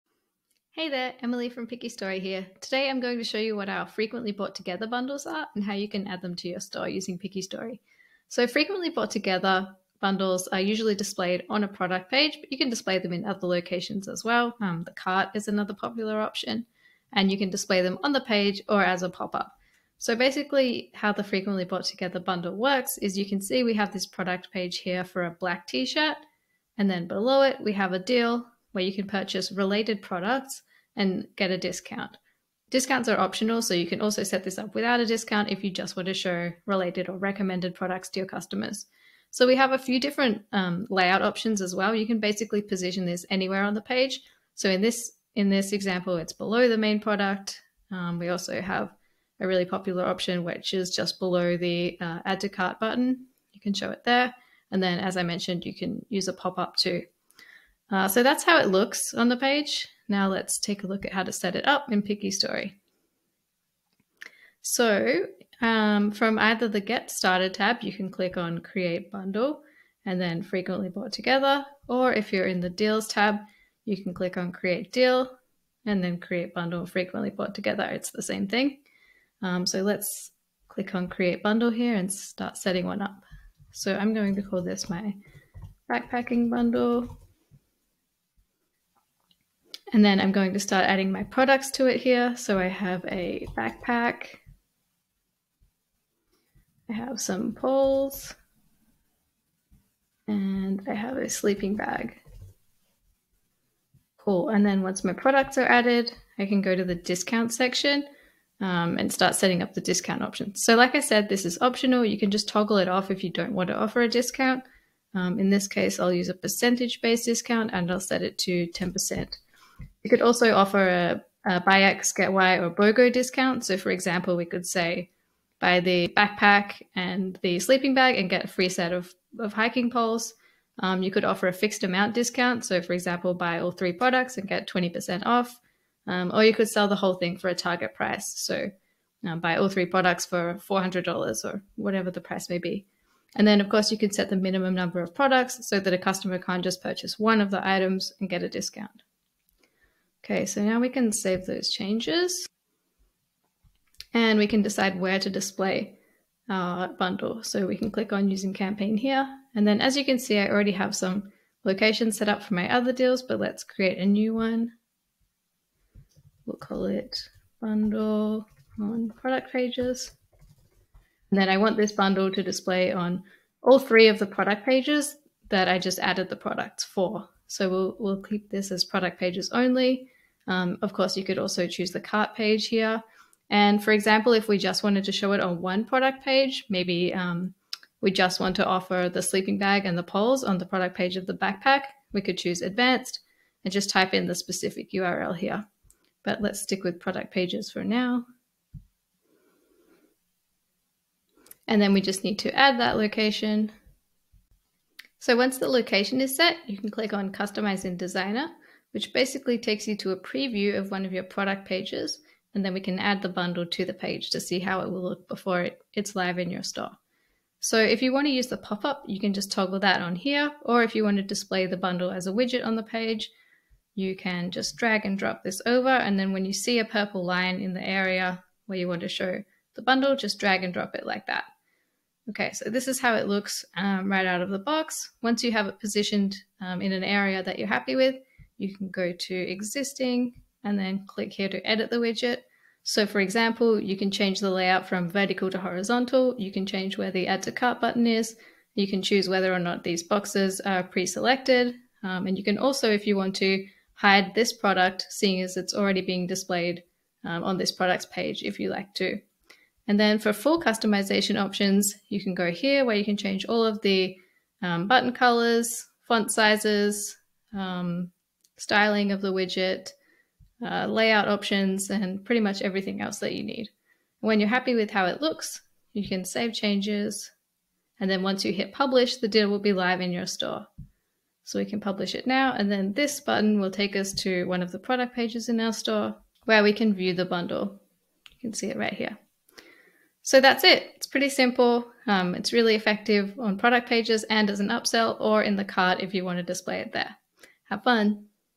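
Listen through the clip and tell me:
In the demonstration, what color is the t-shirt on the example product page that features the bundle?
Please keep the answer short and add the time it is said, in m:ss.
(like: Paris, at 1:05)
Black, at 0:25.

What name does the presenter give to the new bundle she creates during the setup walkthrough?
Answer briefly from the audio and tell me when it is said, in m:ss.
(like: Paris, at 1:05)
Backpacking bundle, at 1:25.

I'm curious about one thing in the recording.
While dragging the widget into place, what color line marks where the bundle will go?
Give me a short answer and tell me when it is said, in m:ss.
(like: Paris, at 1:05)
Purple, at 3:46.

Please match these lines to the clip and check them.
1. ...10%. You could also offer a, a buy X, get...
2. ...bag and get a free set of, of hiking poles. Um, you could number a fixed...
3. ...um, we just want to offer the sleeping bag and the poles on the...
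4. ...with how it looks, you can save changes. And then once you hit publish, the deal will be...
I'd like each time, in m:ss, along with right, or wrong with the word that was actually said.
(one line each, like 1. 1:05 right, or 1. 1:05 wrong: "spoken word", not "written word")
1. 1:58 right
2. 2:07 wrong: "offer", not "number"
3. 3:07 right
4. 4:34 right.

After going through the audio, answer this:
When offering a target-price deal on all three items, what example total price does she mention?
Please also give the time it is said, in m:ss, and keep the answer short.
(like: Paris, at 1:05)
$400, at 2:20.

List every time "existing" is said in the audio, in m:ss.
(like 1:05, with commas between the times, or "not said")
3:59.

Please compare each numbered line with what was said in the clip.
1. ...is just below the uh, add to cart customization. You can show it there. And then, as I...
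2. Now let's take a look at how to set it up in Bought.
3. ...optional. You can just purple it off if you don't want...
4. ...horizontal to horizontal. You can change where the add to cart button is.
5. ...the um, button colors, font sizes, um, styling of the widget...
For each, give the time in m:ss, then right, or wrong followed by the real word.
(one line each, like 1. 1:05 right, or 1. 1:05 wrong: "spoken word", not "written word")
1. 0:50 wrong: "button", not "customization"
2. 1:00 wrong: "PickyStory", not "Bought"
3. 1:51 wrong: "toggle", not "purple"
4. 4:05 wrong: "vertical", not "horizontal"
5. 4:23 right.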